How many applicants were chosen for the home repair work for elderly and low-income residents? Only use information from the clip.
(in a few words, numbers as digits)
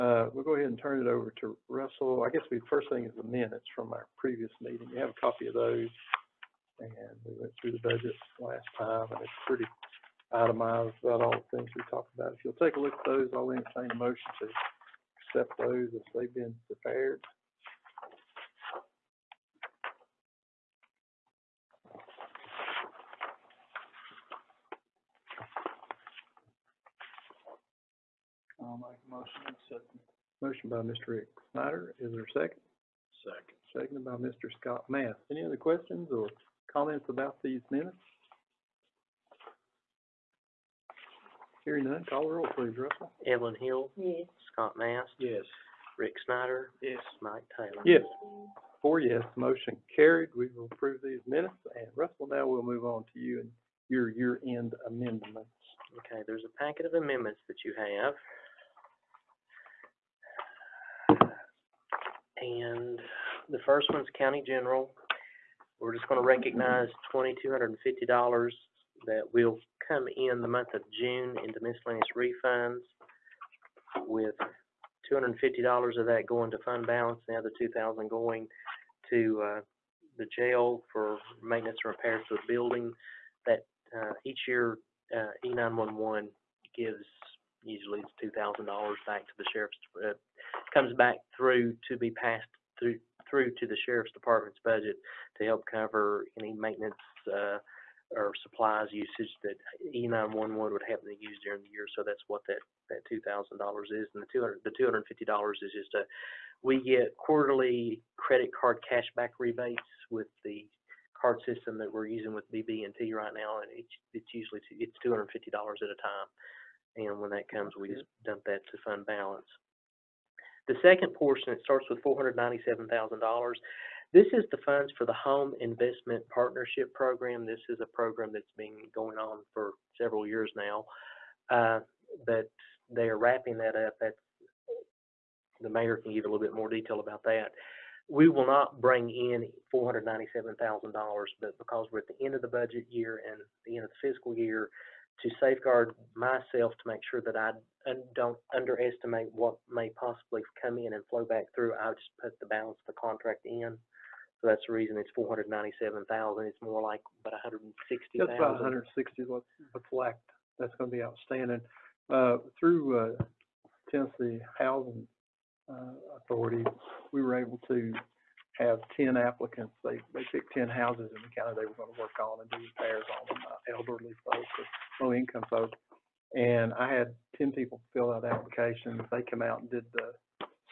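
10.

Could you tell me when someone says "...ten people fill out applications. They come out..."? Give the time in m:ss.
2:57.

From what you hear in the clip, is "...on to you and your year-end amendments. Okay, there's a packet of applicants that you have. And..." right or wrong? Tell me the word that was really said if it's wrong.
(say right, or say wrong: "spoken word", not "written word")
wrong: "amendments", not "applicants".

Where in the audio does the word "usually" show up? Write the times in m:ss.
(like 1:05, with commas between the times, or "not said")
1:27, 1:54.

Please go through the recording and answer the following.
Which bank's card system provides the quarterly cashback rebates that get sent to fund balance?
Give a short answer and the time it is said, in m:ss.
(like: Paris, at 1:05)
BB&T, at 1:52.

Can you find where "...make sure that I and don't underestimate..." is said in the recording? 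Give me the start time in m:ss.
2:26.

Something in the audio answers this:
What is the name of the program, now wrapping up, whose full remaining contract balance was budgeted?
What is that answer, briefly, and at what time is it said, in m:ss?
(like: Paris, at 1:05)
Home Investment Partnership Program, at 2:05.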